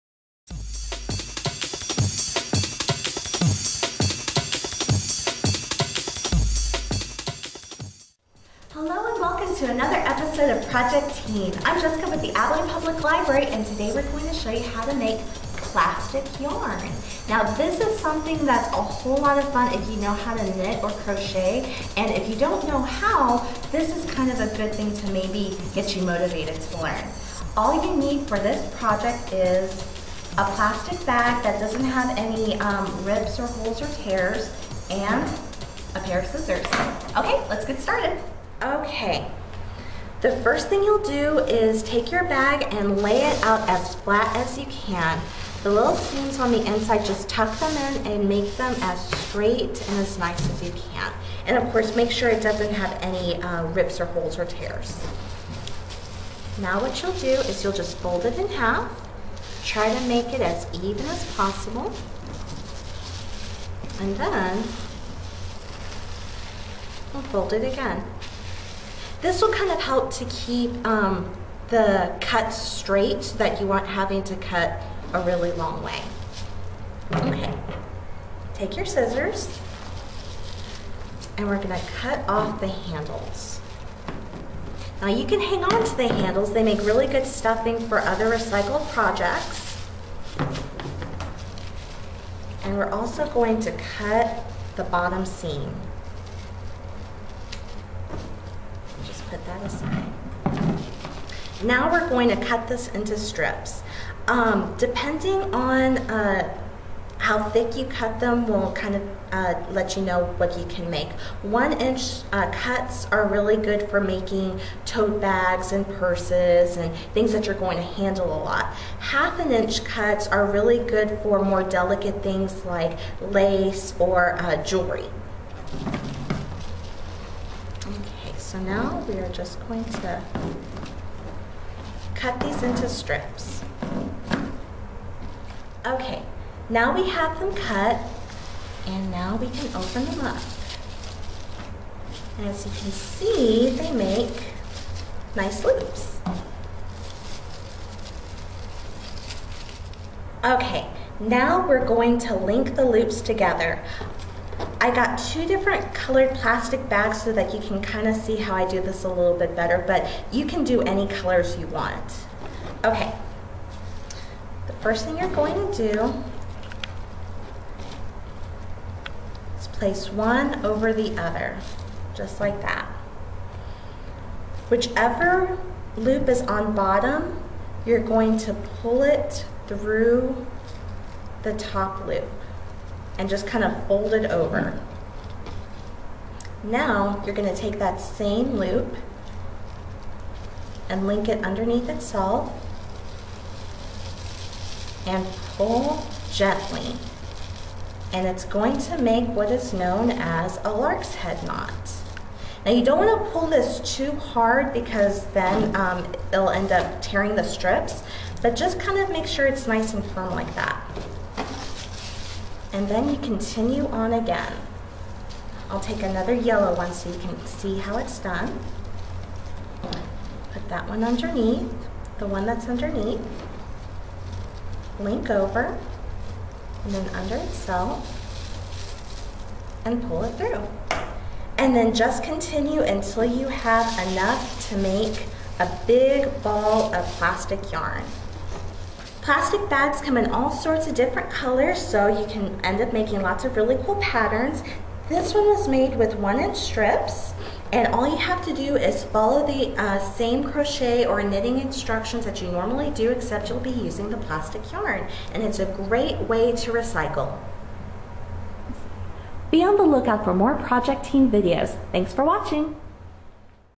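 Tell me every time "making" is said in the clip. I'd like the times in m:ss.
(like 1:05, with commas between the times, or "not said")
1:54, 4:02.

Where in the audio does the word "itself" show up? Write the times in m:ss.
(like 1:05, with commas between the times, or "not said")
3:11, 3:47.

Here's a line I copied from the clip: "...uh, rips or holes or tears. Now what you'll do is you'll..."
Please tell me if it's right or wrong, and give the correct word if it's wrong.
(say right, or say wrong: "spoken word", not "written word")
right.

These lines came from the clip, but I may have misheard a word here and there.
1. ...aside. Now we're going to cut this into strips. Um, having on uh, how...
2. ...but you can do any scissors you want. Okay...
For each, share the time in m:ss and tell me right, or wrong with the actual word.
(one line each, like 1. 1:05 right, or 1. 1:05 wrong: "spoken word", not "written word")
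1. 1:39 wrong: "depending", not "having"
2. 2:39 wrong: "colors", not "scissors".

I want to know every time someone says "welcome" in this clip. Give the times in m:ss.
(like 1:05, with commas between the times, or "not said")
0:09.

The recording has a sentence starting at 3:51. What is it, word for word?
And then just continue until you have enough to make a big ball of plastic yarn.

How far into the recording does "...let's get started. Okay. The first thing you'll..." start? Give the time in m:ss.
0:37.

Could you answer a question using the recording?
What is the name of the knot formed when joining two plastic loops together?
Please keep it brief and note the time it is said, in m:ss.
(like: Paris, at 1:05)
lark's head knot, at 3:20.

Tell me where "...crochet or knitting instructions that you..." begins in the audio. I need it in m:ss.
4:10.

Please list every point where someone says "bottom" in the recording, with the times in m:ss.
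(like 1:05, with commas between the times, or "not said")
1:34, 2:56.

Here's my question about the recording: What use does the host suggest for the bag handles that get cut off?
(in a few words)
stuffing.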